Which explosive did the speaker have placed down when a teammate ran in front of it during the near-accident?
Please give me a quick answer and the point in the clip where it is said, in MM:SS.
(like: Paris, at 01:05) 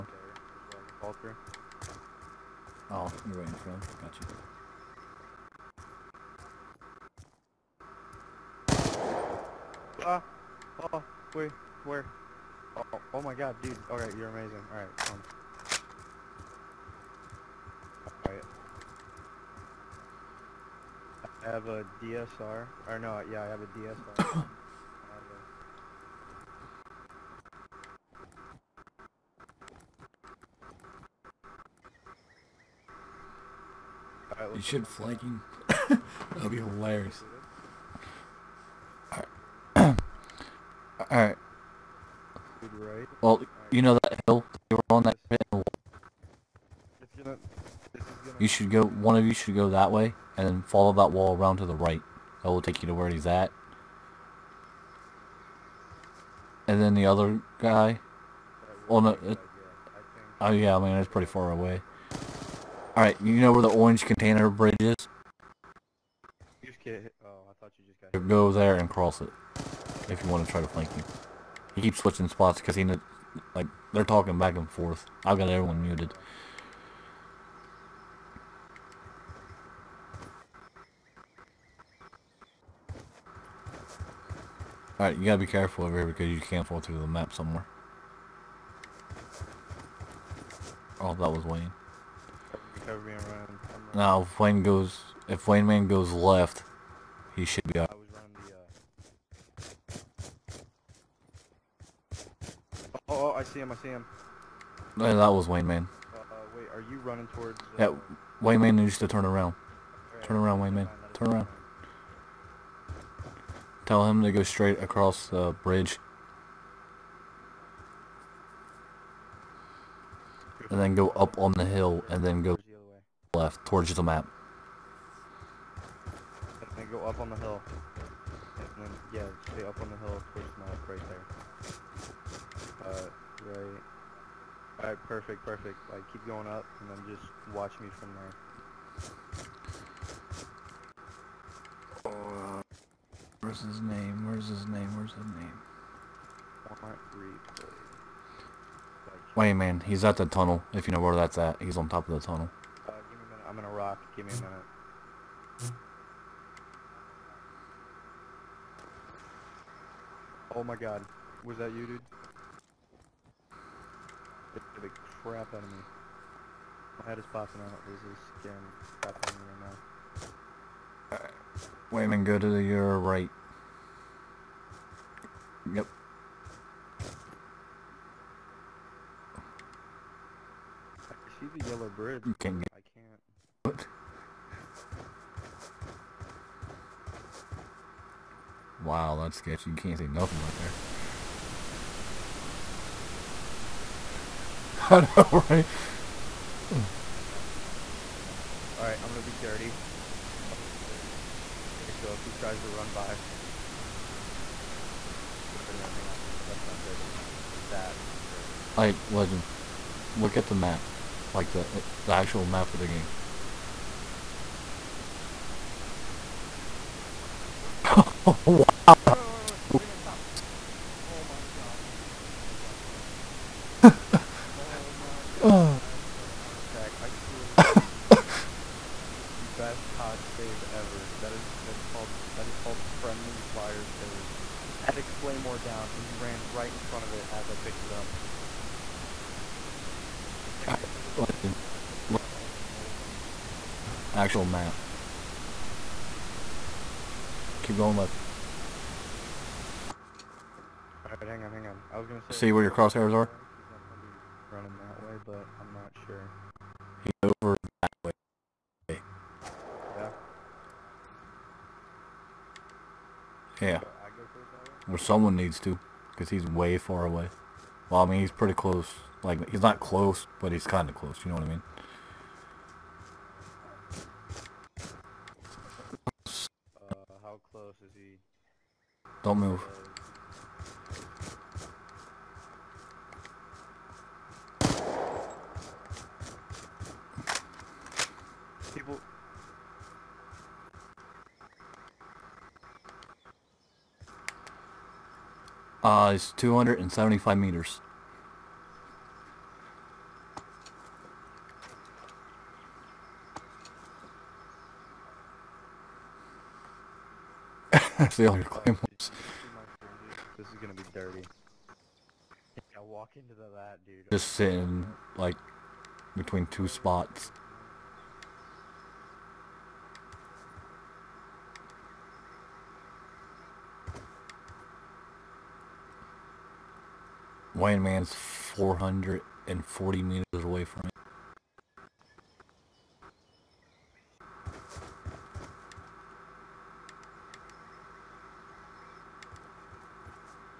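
Claymore, at 03:55.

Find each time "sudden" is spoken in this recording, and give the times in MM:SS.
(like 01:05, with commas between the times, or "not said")
not said.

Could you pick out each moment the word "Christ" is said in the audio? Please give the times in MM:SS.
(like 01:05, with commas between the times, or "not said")
04:03.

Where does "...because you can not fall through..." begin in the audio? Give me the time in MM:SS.
01:26.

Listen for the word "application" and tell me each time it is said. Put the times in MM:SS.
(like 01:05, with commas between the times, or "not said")
not said.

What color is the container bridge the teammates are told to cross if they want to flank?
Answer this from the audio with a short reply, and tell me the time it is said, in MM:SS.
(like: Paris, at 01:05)
Orange, at 01:03.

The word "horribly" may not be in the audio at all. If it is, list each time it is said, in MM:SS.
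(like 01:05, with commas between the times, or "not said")
not said.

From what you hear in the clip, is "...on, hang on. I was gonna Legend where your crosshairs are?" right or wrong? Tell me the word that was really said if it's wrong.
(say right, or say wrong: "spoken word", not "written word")
wrong: "See", not "Legend".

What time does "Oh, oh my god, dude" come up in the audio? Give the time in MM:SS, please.
00:12.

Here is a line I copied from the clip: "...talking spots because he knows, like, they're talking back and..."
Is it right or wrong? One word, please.
wrong.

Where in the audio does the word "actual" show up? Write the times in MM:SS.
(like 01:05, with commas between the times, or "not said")
03:32, 04:04.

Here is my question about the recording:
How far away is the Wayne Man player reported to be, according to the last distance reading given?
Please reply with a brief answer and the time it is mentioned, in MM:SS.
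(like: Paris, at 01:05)
440 meters, at 05:28.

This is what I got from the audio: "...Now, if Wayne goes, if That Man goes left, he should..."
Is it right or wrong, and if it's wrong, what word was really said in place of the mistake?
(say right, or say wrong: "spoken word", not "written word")
wrong: "Wayne", not "That".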